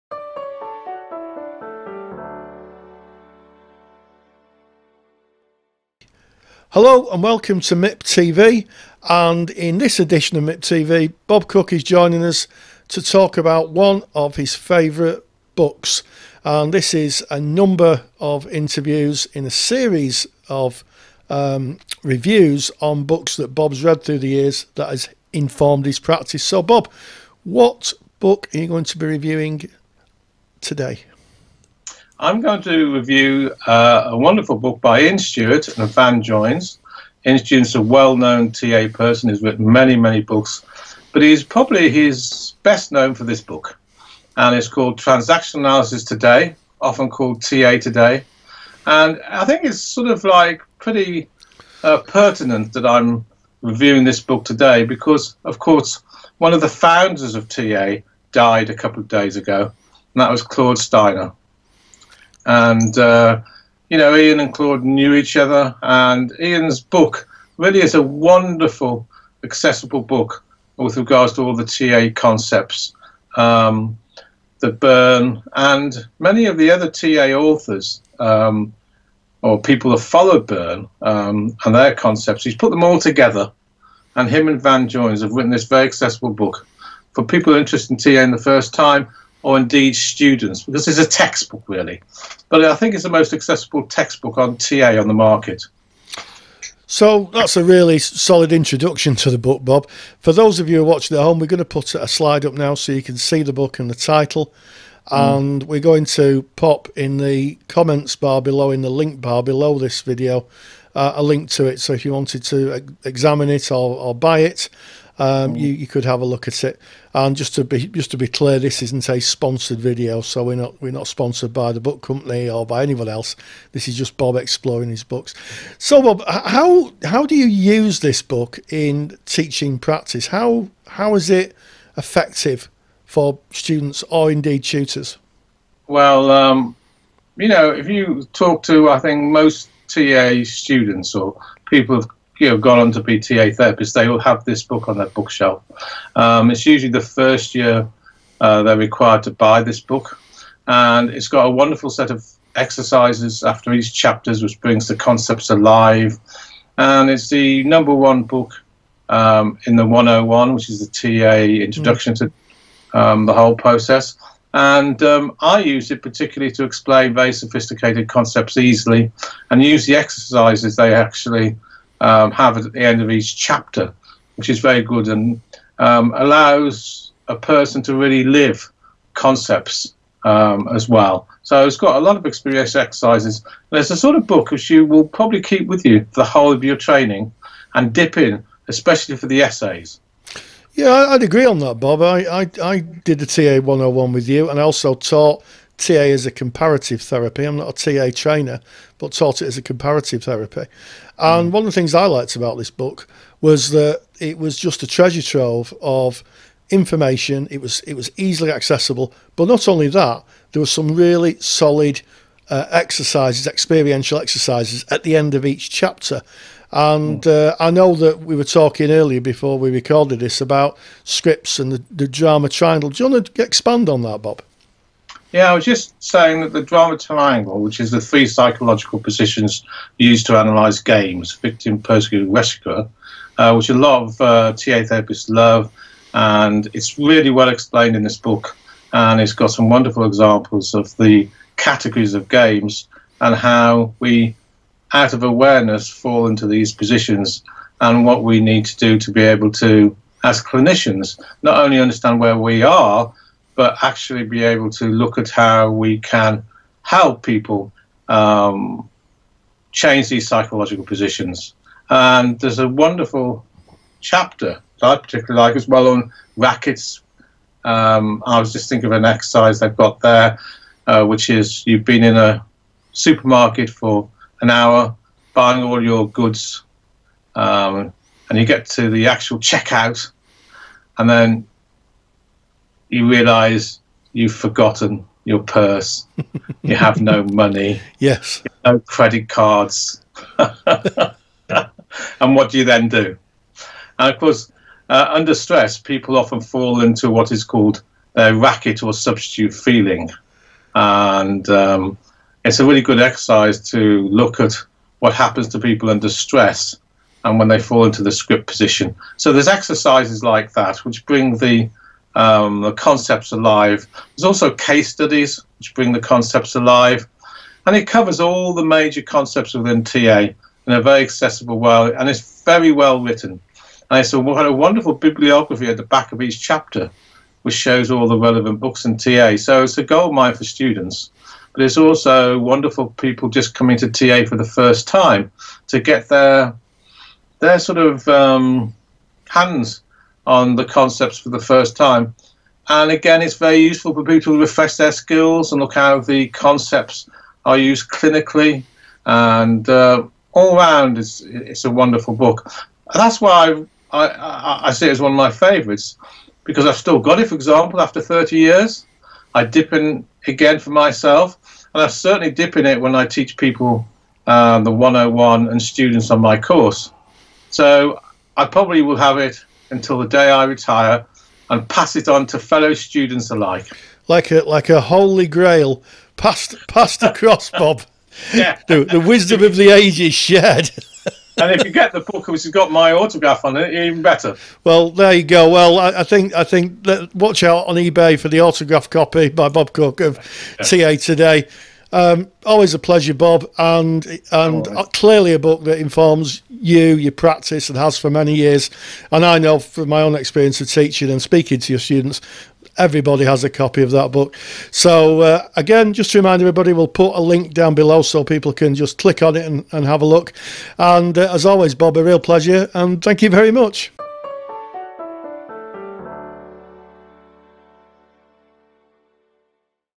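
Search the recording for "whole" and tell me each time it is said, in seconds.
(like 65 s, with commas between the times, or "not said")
163 s, 186 s.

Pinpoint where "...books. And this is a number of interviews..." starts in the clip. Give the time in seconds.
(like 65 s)
15 s.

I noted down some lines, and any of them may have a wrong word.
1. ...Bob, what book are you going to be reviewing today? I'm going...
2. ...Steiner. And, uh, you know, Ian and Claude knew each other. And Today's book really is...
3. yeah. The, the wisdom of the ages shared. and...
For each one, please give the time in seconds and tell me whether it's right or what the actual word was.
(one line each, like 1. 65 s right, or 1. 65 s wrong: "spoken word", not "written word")
1. 26 s right
2. 60 s wrong: "Ian", not "Today"
3. 378 s right.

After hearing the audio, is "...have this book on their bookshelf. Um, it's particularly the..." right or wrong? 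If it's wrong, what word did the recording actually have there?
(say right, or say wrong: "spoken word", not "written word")
wrong: "usually", not "particularly".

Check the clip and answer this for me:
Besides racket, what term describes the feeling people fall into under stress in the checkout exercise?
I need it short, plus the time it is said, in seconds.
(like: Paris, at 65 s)
substitute feeling, at 298 s.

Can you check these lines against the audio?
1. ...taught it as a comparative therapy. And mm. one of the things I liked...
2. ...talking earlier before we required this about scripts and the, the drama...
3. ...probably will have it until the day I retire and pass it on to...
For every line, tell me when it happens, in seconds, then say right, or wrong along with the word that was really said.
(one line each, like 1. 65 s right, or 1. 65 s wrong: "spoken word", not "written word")
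1. 199 s right
2. 218 s wrong: "recorded", not "required"
3. 368 s right.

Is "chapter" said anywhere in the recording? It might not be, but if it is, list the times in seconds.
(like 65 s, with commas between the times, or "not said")
153 s, 173 s, 215 s, 263 s, 326 s.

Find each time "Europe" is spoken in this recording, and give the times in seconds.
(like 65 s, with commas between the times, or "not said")
not said.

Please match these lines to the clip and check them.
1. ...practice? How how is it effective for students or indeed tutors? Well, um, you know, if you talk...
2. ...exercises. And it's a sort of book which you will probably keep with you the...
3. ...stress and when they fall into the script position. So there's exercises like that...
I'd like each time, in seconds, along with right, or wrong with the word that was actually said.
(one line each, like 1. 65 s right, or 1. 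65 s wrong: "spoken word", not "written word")
1. 129 s right
2. 182 s right
3. 306 s right.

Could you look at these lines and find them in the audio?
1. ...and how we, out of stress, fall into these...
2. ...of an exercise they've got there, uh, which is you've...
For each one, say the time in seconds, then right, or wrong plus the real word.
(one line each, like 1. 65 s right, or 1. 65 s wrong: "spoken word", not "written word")
1. 243 s wrong: "awareness", not "stress"
2. 268 s right.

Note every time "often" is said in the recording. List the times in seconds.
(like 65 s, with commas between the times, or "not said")
46 s, 296 s.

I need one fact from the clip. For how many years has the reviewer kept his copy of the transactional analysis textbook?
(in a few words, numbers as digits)
30.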